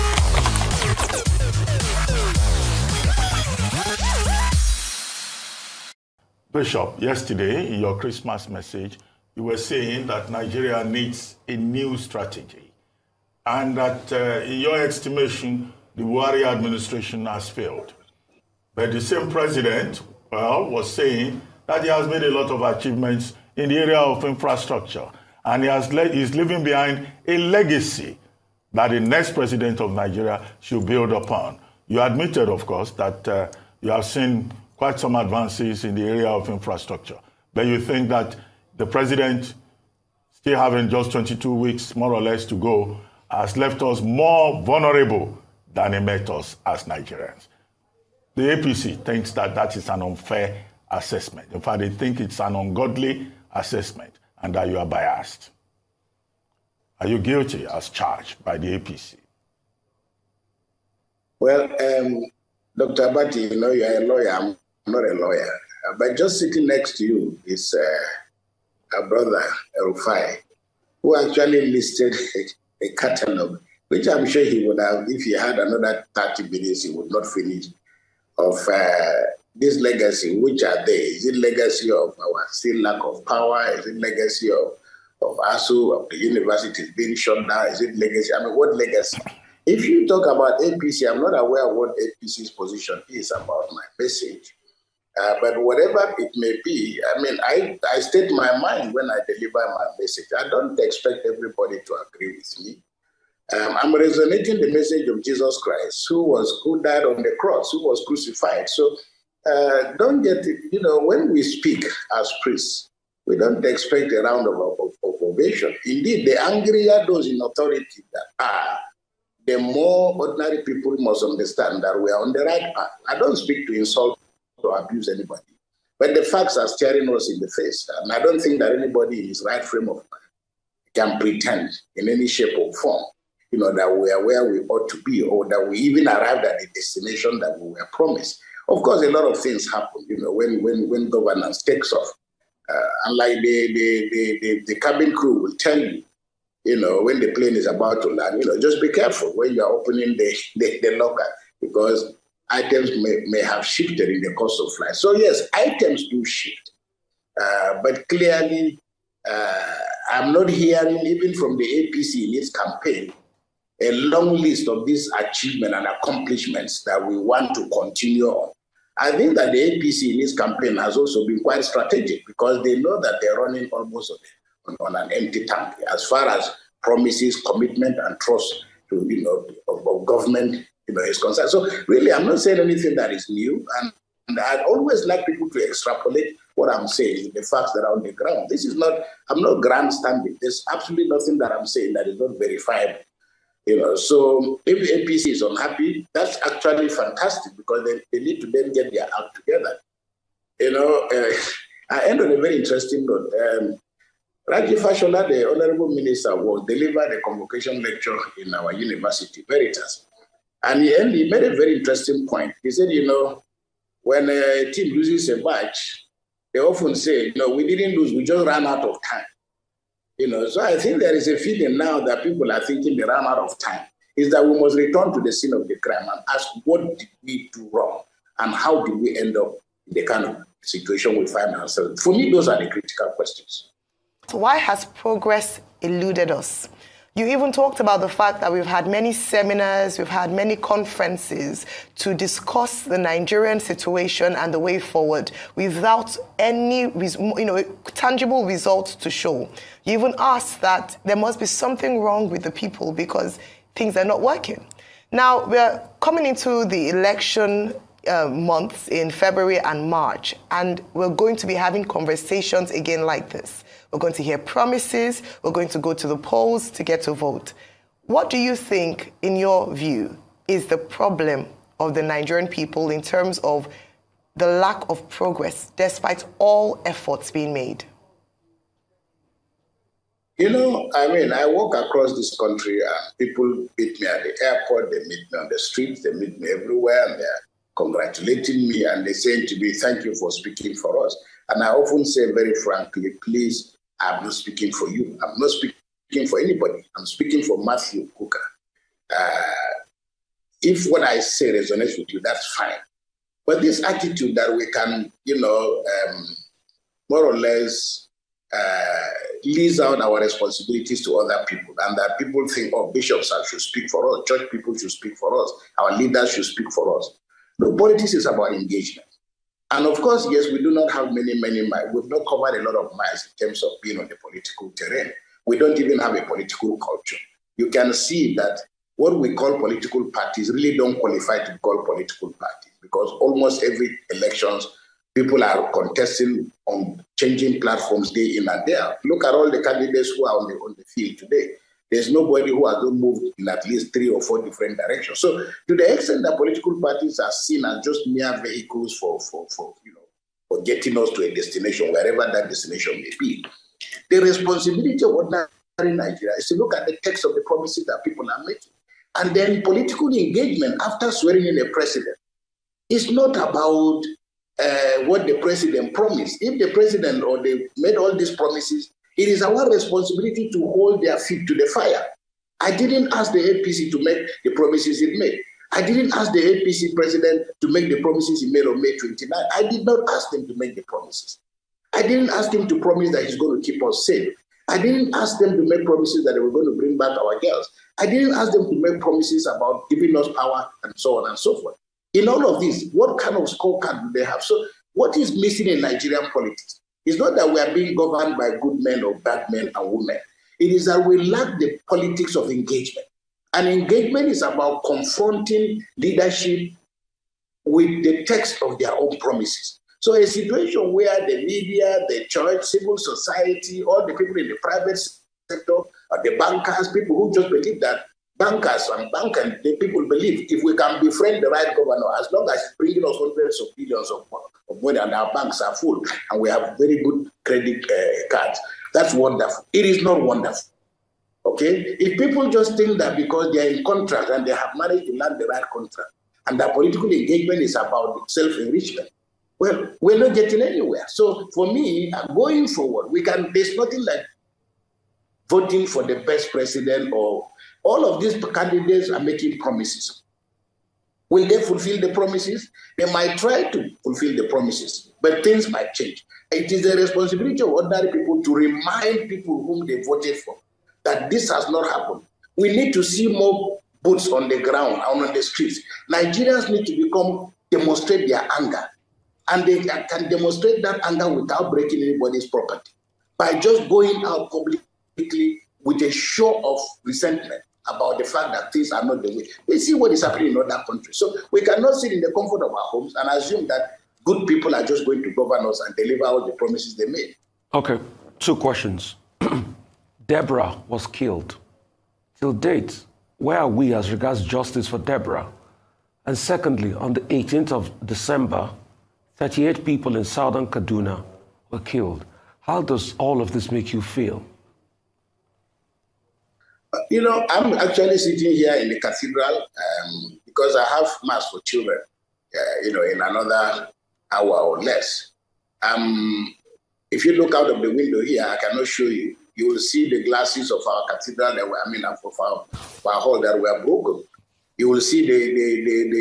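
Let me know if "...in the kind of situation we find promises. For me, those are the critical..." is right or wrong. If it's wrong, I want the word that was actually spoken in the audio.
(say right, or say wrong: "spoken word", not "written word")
wrong: "ourselves", not "promises".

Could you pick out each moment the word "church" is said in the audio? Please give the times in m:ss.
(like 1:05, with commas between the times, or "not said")
5:14, 6:52.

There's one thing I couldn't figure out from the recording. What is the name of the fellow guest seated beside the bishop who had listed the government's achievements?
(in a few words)
Rufai.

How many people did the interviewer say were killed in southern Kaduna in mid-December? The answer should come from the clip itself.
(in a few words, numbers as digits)
38.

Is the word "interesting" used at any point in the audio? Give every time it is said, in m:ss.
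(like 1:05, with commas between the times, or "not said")
3:22, 3:31.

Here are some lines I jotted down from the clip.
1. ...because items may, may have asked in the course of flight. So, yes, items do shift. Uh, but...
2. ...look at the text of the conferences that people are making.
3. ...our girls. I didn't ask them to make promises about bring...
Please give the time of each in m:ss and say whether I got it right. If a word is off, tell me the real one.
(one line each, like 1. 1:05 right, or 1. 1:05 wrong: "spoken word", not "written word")
1. 2:31 wrong: "shifted", not "asked"
2. 5:56 wrong: "promises", not "conferences"
3. 6:27 wrong: "giving", not "bring".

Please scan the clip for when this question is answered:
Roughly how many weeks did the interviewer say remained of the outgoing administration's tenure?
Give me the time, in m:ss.
0:41.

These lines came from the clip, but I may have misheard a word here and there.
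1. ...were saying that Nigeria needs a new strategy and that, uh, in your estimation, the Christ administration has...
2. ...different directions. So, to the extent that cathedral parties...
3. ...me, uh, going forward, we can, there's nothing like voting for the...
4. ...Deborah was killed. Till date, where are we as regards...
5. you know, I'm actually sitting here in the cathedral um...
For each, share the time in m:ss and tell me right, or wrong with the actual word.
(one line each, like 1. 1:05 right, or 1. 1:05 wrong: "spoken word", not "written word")
1. 0:09 wrong: "Buhari", not "Christ"
2. 5:44 wrong: "political", not "cathedral"
3. 7:21 right
4. 8:10 right
5. 8:27 right.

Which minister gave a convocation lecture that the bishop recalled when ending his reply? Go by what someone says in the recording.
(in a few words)
Raji Fashola.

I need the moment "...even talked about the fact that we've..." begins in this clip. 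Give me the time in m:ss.
3:57.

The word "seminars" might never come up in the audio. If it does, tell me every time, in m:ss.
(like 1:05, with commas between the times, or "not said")
3:59.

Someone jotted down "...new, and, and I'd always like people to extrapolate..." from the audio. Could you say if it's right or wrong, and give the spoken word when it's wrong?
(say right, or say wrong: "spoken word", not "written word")
right.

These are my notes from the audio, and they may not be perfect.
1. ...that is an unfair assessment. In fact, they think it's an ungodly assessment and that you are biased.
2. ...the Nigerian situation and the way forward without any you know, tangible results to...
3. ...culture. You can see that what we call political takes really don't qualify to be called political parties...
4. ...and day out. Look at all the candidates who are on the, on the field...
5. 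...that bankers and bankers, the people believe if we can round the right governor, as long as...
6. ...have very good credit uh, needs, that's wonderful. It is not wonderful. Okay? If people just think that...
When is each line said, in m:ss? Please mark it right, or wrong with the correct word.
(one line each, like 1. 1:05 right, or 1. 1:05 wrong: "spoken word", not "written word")
1. 0:49 right
2. 4:02 right
3. 5:26 wrong: "parties", not "takes"
4. 5:38 right
5. 6:57 wrong: "befriend", not "round"
6. 7:06 wrong: "cards", not "needs".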